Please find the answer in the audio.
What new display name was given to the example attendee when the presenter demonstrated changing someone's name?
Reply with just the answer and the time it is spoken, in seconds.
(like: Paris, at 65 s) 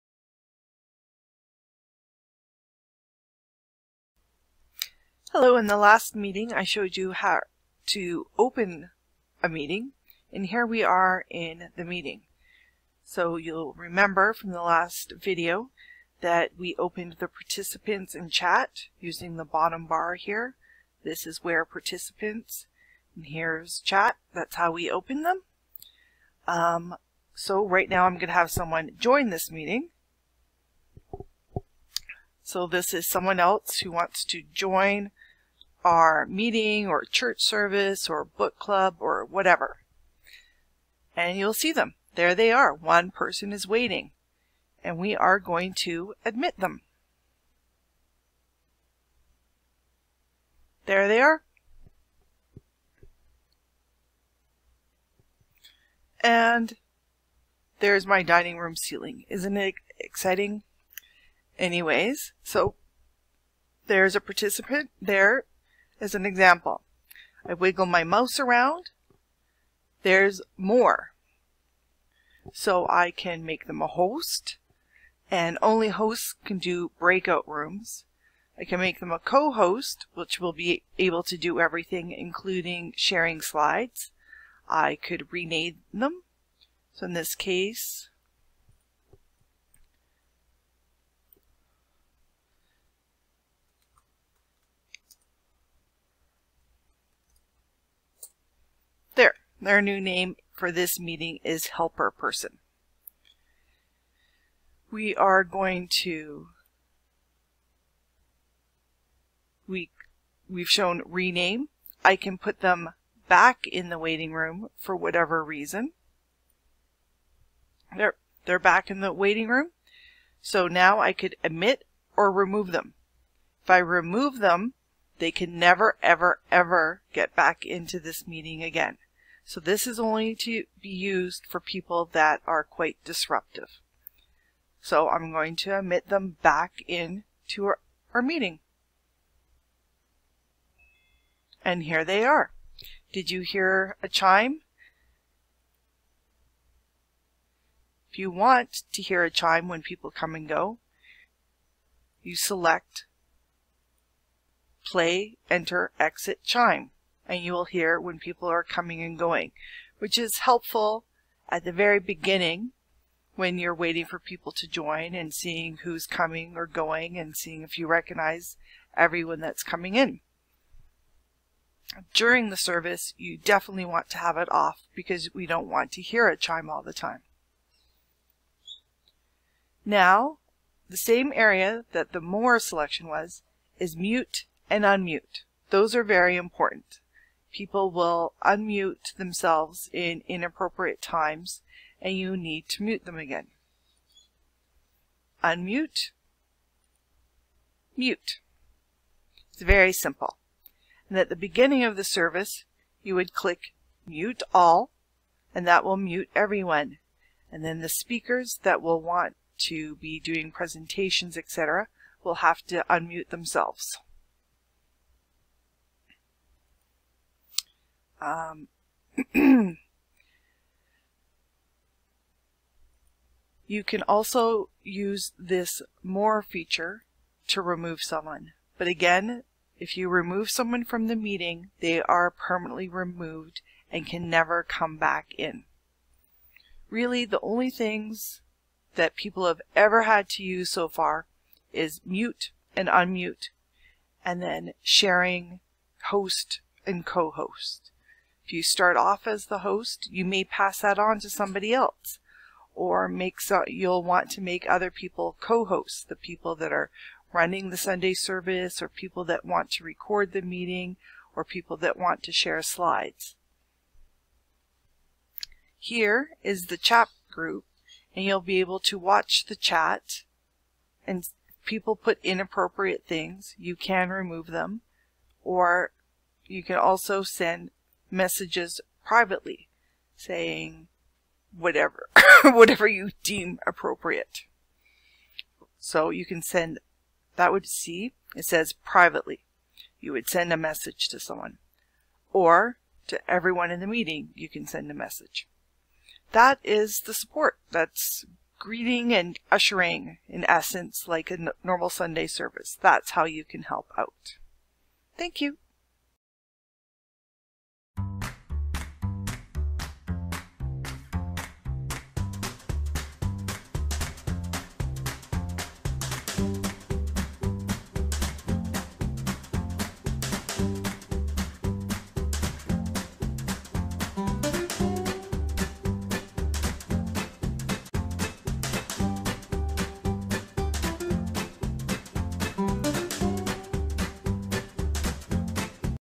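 helper person, at 101 s.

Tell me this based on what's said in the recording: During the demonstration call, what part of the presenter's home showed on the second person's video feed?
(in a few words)
dining room ceiling.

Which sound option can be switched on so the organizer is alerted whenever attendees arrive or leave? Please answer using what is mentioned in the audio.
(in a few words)
play, enter, exit, chime.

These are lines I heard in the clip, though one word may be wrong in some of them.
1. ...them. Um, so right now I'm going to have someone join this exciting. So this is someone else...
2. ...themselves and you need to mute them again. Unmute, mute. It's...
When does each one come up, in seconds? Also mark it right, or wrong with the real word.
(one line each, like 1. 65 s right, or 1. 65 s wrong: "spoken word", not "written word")
1. 25 s wrong: "meeting", not "exciting"
2. 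191 s wrong: "times", not "themselves".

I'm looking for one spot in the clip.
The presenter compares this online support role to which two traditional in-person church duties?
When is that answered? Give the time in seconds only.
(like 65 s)
298 s.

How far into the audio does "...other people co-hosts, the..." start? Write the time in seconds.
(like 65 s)
254 s.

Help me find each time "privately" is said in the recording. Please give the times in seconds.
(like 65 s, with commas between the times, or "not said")
279 s, 288 s.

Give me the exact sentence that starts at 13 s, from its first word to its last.
So you'll remember from the last video that we opened the participants in chat using the bottom bar here.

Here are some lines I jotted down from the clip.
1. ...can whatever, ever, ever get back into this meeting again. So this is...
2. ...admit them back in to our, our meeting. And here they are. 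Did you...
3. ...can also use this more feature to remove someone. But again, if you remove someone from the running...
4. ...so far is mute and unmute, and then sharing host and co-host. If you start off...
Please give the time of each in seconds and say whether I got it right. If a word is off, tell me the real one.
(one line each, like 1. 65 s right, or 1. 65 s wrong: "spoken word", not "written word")
1. 125 s wrong: "never", not "whatever"
2. 135 s right
3. 223 s wrong: "meeting", not "running"
4. 240 s right.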